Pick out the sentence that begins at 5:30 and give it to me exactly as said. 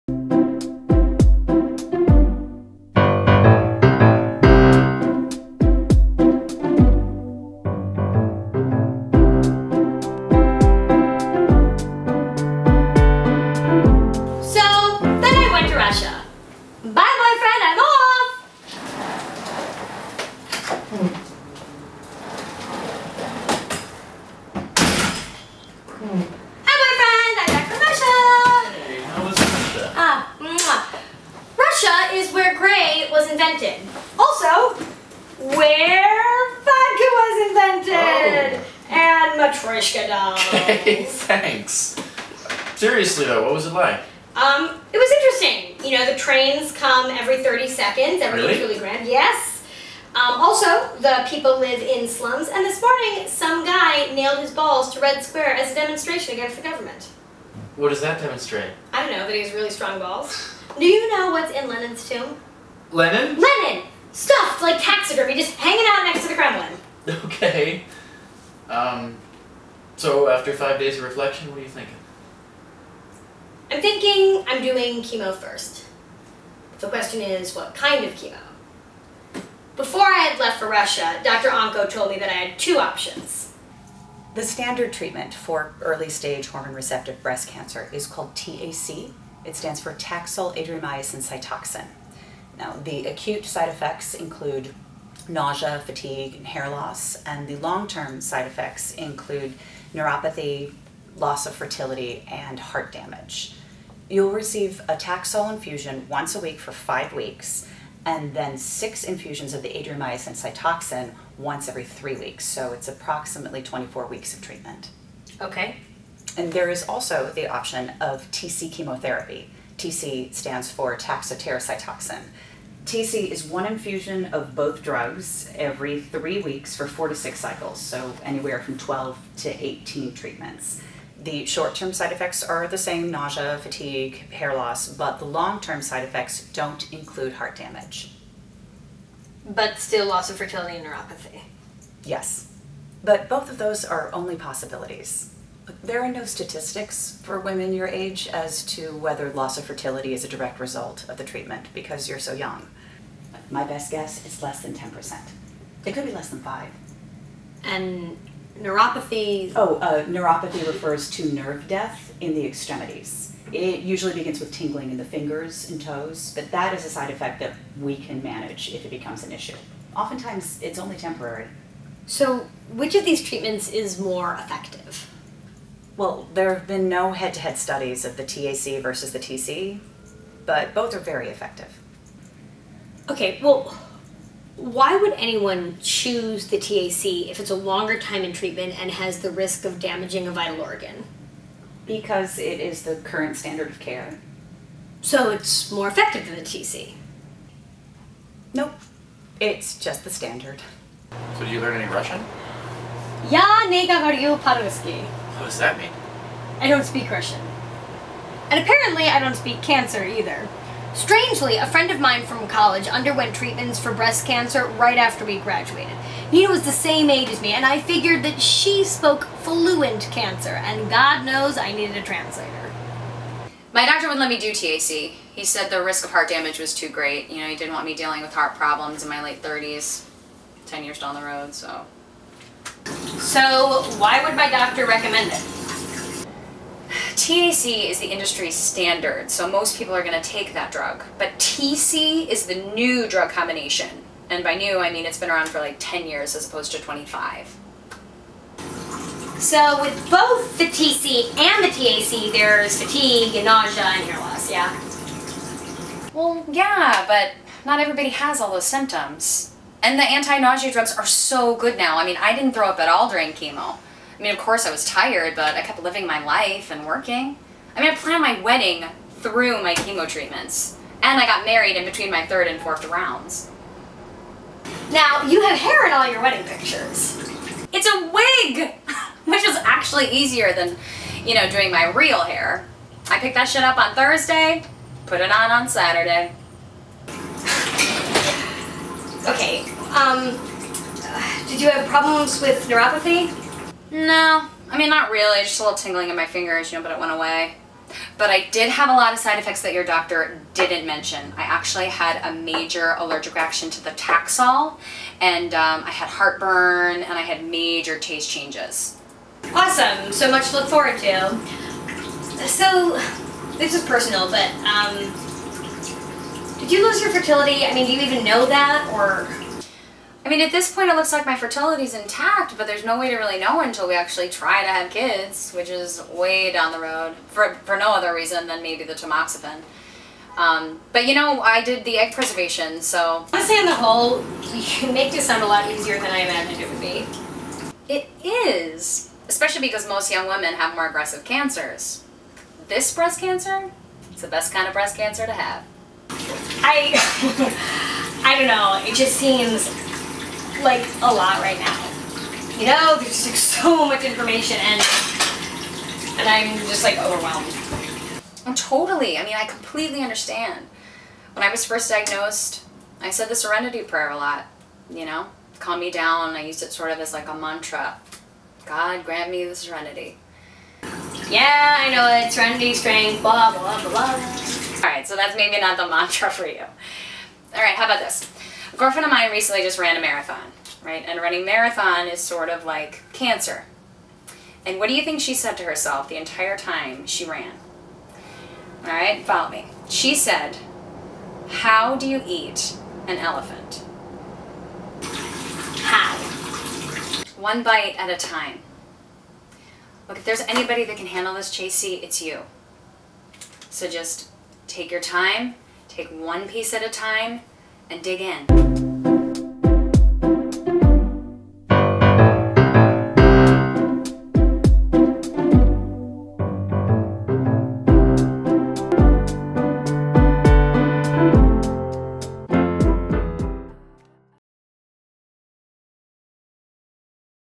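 Um, but you know, I did the egg preservation, so...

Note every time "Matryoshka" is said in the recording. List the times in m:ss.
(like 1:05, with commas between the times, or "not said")
0:39.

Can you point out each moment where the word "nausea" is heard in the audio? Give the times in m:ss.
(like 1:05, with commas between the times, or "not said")
1:35, 2:13, 4:13, 4:20.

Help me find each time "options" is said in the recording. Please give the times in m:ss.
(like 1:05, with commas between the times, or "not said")
1:22, 1:57.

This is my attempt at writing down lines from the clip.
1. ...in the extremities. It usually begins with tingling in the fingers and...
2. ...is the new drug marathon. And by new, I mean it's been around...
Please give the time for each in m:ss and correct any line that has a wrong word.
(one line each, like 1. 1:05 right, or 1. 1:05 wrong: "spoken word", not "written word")
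1. 2:42 right
2. 4:02 wrong: "combination", not "marathon".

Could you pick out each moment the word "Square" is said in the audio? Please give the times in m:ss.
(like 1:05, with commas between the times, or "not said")
0:55.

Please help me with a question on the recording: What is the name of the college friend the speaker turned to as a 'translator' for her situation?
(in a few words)
Nina.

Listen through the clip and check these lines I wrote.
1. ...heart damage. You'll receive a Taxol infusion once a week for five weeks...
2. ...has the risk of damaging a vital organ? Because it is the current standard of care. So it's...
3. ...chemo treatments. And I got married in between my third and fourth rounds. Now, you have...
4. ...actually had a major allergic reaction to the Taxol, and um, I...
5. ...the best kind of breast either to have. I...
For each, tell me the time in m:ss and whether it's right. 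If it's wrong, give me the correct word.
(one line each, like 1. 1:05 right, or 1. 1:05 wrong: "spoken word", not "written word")
1. 1:42 right
2. 3:08 right
3. 4:29 right
4. 5:01 right
5. 5:44 wrong: "cancer", not "either".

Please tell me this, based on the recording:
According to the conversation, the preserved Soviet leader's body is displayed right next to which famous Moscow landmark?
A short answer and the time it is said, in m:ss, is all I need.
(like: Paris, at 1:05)
the Kremlin, at 1:06.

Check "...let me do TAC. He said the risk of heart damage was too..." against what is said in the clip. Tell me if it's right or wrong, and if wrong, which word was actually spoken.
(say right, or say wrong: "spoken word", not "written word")
right.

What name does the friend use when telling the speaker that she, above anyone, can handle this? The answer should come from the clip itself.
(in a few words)
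Jacey.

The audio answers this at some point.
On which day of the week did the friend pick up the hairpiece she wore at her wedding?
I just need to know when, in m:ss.
4:43.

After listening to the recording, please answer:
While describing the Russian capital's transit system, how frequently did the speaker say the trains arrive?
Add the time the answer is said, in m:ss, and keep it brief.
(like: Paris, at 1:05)
every 30 seconds, at 0:47.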